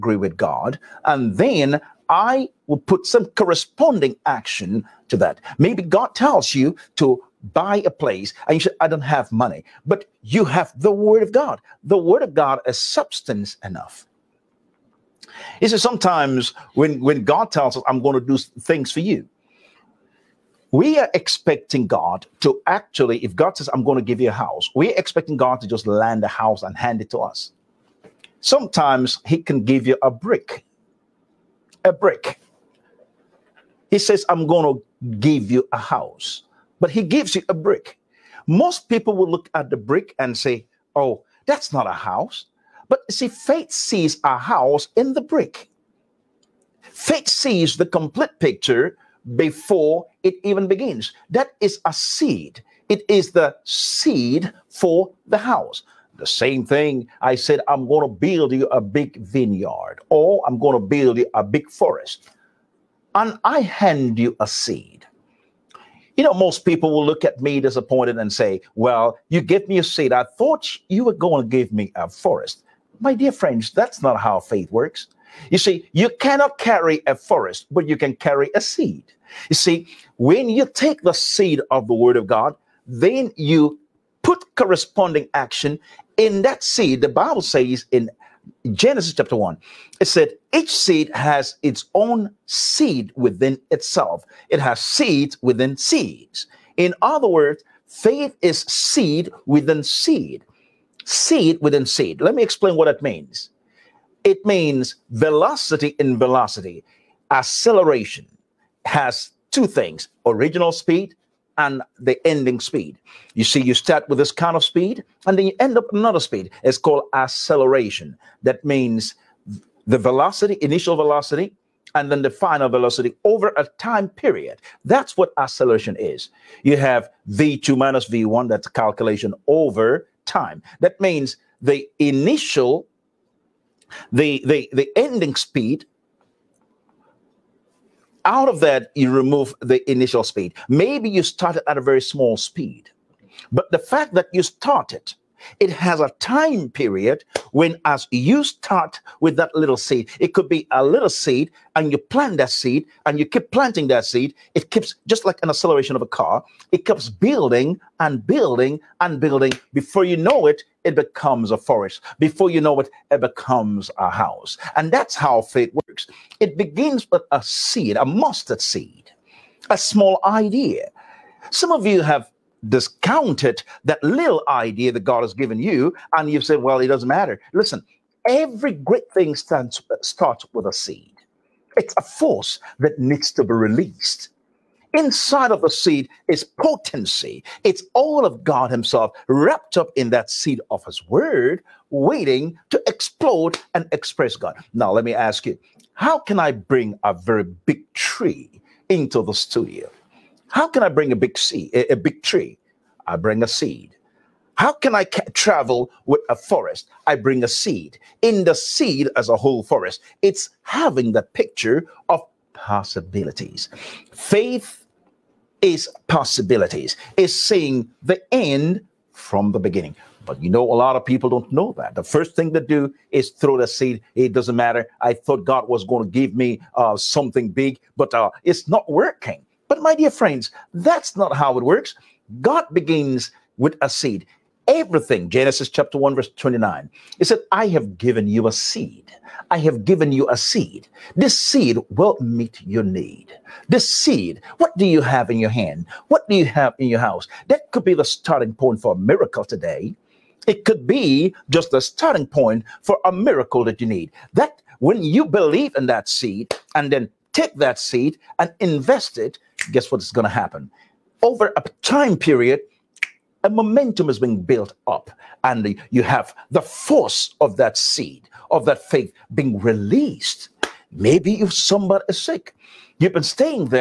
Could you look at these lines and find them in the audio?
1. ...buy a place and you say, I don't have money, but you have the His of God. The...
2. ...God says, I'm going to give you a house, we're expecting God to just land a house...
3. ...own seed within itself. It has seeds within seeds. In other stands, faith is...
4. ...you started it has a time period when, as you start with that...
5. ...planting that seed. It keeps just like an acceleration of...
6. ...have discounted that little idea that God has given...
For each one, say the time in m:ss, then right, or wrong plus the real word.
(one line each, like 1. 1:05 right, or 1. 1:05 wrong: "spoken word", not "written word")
1. 0:07 wrong: "Word", not "His"
2. 0:23 right
3. 1:31 wrong: "words", not "stands"
4. 2:24 right
5. 2:33 right
6. 2:52 right.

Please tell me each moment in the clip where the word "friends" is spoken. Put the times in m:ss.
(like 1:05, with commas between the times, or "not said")
1:13, 3:50.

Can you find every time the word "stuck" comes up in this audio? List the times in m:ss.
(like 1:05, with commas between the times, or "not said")
not said.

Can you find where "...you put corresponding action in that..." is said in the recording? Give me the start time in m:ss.
1:23.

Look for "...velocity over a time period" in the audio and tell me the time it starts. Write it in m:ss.
2:02.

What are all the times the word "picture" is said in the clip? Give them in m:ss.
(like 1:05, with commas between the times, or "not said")
0:48, 3:31.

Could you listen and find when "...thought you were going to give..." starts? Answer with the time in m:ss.
1:10.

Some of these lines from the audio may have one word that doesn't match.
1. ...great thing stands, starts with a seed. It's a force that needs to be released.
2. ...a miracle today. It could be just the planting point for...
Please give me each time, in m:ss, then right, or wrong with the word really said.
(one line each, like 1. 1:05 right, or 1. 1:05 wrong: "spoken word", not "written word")
1. 2:58 right
2. 4:08 wrong: "starting", not "planting".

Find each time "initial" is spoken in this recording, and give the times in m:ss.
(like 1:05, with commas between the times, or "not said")
2:00, 2:11, 2:19.